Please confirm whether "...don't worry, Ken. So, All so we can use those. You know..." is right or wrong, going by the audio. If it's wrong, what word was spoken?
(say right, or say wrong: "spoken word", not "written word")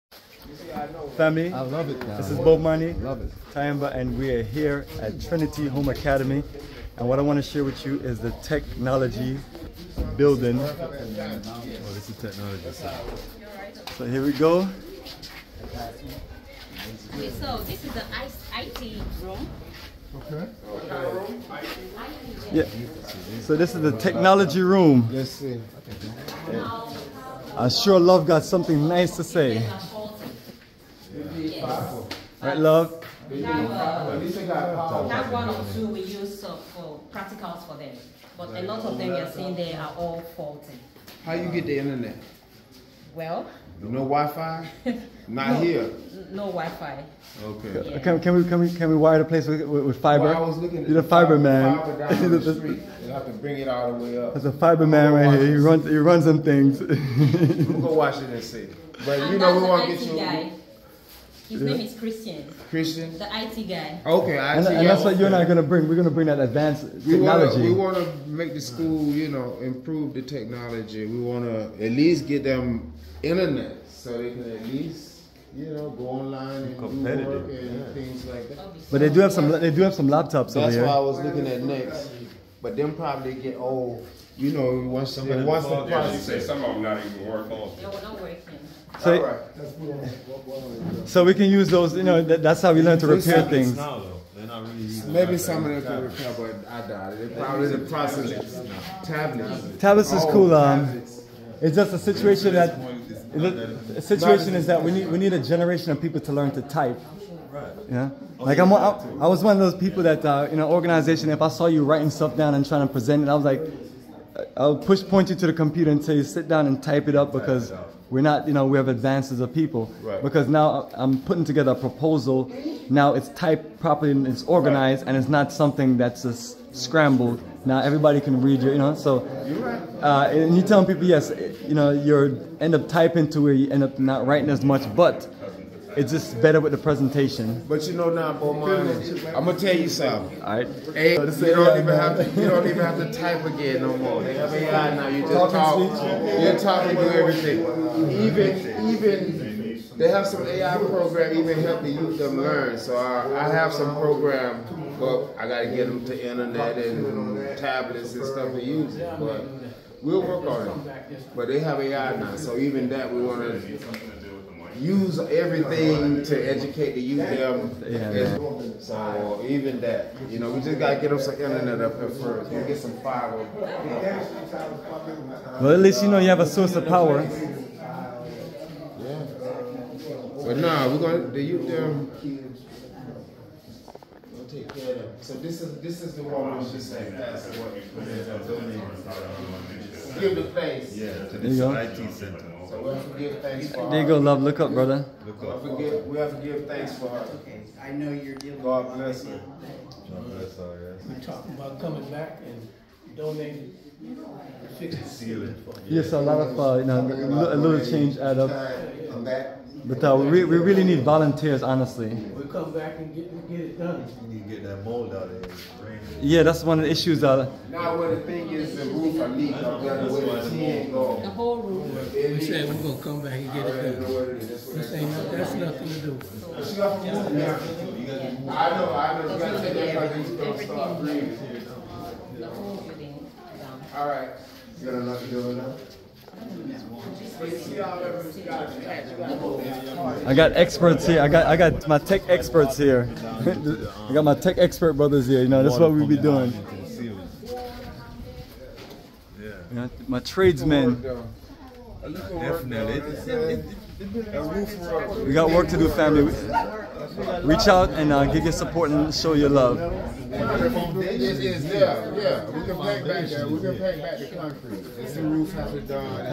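right.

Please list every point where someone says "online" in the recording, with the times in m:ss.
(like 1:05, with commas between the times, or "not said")
1:16.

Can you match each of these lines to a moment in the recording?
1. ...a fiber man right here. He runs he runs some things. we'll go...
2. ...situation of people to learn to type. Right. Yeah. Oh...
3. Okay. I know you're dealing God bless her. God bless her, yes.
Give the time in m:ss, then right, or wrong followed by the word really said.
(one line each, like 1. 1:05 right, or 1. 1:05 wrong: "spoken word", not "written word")
1. 0:54 right
2. 1:45 wrong: "generation", not "situation"
3. 3:17 right.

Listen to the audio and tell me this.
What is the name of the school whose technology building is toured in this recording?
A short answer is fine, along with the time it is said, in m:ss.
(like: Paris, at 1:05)
Trinity Home Academy, at 0:05.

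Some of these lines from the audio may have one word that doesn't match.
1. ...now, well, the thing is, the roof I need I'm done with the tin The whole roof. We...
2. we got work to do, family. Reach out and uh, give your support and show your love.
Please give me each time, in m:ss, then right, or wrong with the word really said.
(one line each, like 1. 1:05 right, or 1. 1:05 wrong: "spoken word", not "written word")
1. 3:37 right
2. 4:15 right.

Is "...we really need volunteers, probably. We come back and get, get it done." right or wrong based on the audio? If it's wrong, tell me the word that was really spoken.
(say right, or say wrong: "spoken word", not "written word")
wrong: "honestly", not "probably".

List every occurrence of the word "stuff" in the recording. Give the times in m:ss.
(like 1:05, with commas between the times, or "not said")
1:52, 2:38.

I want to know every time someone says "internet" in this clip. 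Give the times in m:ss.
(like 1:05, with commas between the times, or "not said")
0:41, 1:13, 2:36, 2:51.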